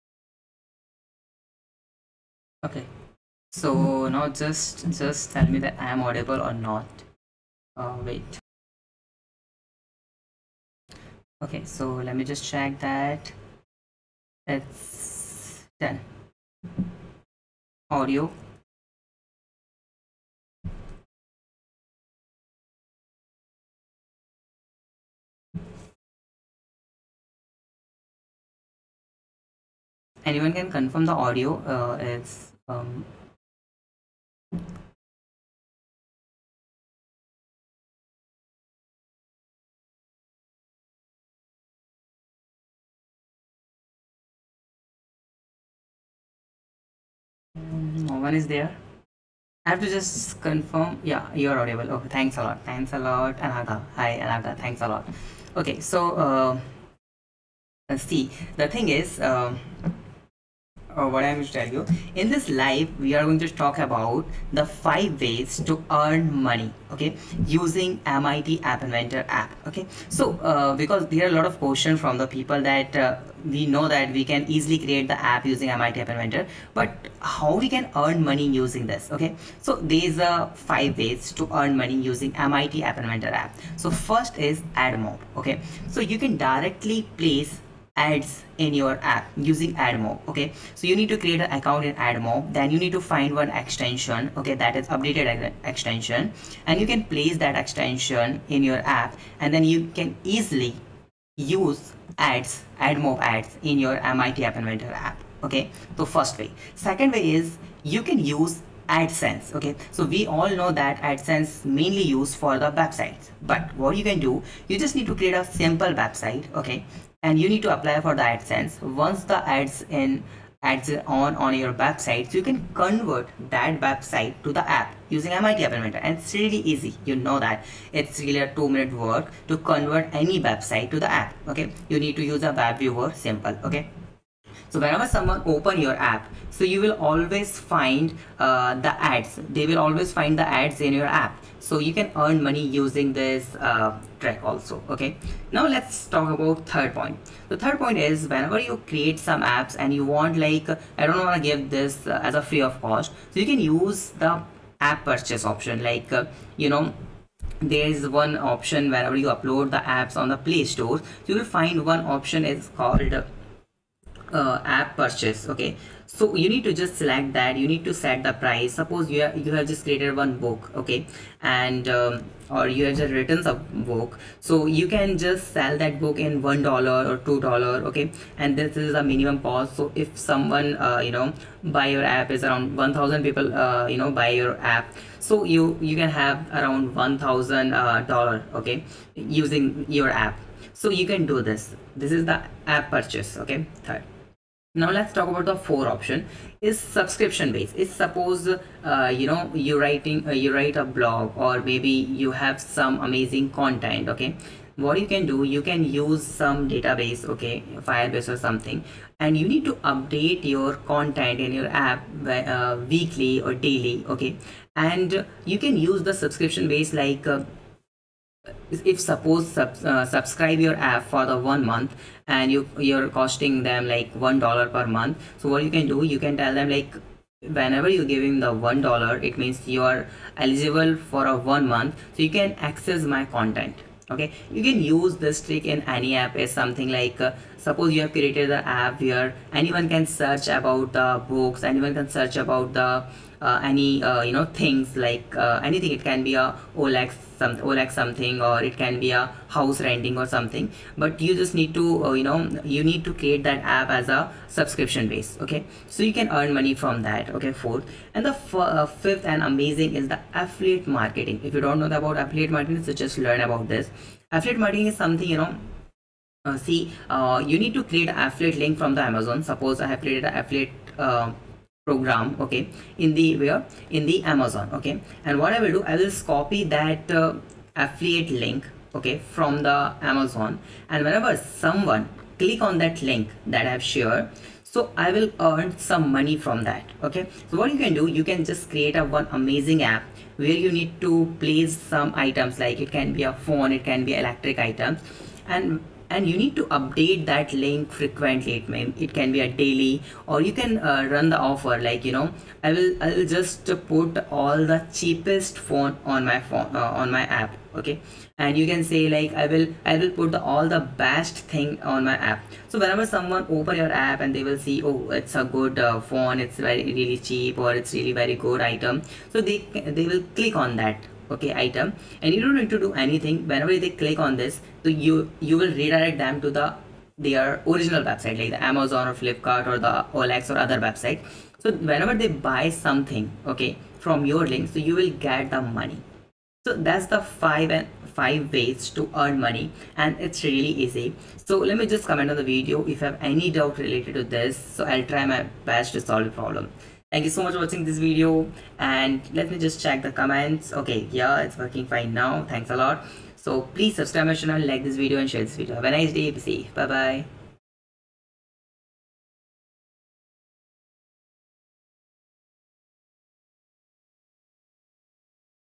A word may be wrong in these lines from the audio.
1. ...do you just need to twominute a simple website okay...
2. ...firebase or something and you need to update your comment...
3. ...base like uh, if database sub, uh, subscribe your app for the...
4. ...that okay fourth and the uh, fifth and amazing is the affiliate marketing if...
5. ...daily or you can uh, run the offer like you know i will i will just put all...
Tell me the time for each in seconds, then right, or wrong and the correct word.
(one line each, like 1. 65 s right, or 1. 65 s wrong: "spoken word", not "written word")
1. 114 s wrong: "create", not "twominute"
2. 207 s wrong: "content", not "comment"
3. 216 s wrong: "suppose", not "database"
4. 257 s right
5. 299 s right.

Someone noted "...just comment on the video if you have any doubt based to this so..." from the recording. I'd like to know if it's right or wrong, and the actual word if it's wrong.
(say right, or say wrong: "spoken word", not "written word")
wrong: "related", not "based".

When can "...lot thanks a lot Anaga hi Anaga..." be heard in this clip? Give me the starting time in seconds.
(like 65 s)
52 s.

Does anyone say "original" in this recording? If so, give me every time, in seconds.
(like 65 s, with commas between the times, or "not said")
327 s.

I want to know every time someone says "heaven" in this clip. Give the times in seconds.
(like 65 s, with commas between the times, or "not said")
not said.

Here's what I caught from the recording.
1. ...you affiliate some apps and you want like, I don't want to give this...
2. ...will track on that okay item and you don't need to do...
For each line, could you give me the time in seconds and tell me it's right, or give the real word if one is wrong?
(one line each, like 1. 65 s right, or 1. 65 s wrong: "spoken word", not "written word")
1. 148 s wrong: "create", not "affiliate"
2. 320 s wrong: "click", not "track".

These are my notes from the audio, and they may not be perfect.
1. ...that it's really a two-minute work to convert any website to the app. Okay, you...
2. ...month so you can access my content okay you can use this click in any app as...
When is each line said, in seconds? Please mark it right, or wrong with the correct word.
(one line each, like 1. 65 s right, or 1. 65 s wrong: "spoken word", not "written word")
1. 127 s right
2. 231 s wrong: "trick", not "click".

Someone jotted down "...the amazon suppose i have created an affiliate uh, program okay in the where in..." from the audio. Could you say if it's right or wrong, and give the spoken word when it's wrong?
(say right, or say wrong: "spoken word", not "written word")
right.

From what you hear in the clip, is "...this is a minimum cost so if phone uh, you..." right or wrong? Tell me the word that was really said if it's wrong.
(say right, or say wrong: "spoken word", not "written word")
wrong: "someone", not "phone".